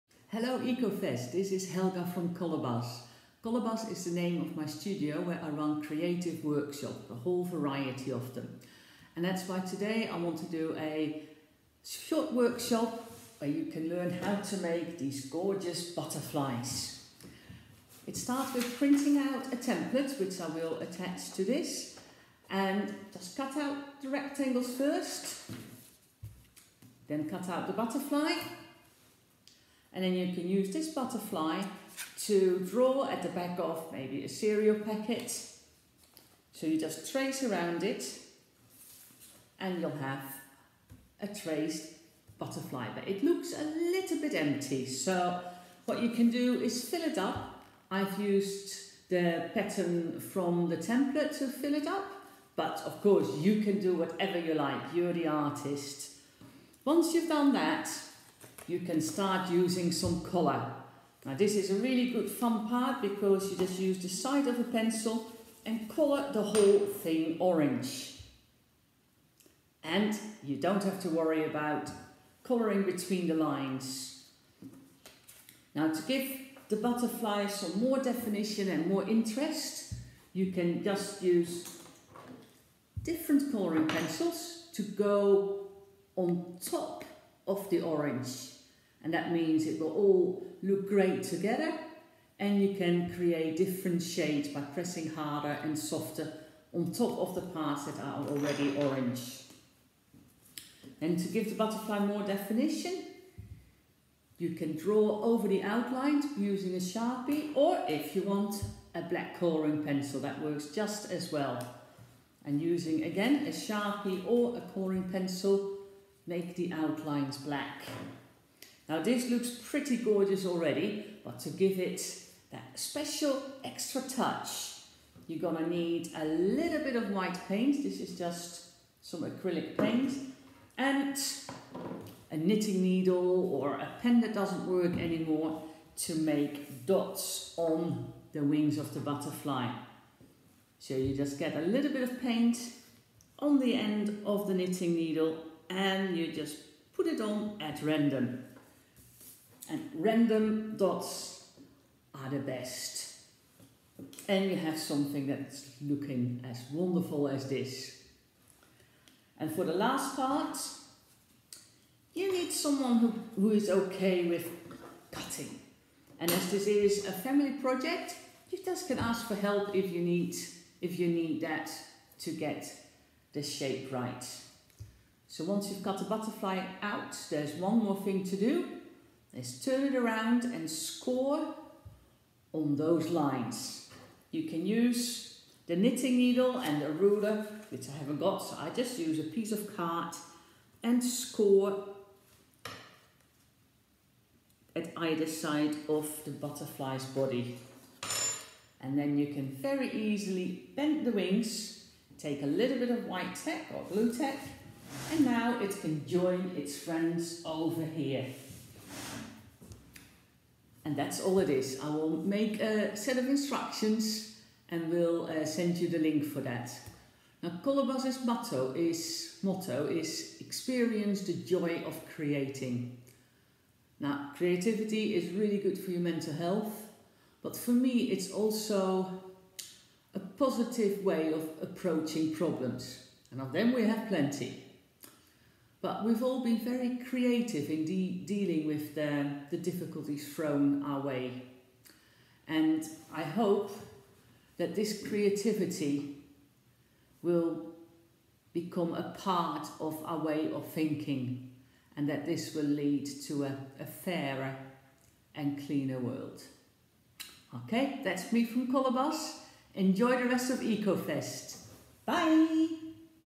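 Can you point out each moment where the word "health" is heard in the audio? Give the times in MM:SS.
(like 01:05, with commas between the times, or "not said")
03:46.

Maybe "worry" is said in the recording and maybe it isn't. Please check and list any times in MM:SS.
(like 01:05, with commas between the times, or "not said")
01:11.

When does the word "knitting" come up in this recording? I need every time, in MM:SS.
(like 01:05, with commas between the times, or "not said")
02:12, 02:24, 03:05.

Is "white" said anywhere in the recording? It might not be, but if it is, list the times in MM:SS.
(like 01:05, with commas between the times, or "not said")
02:07, 03:23.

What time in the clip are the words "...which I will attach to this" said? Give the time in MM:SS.
00:20.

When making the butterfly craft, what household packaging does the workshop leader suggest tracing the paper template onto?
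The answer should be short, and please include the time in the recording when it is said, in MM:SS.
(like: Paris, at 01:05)
cereal packet, at 00:34.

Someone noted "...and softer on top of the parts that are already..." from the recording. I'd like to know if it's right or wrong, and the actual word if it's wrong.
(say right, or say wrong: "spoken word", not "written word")
right.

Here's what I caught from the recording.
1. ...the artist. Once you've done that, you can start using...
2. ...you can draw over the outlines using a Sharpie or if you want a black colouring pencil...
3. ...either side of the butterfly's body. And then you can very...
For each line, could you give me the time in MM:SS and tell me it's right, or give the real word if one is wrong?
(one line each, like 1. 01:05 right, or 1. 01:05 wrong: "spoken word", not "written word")
1. 00:55 right
2. 01:44 right
3. 03:14 right.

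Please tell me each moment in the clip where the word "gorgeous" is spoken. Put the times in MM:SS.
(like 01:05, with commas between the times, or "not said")
00:15, 01:59.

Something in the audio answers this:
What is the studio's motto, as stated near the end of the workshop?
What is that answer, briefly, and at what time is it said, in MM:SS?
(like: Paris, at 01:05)
Experience the joy of creating, at 03:40.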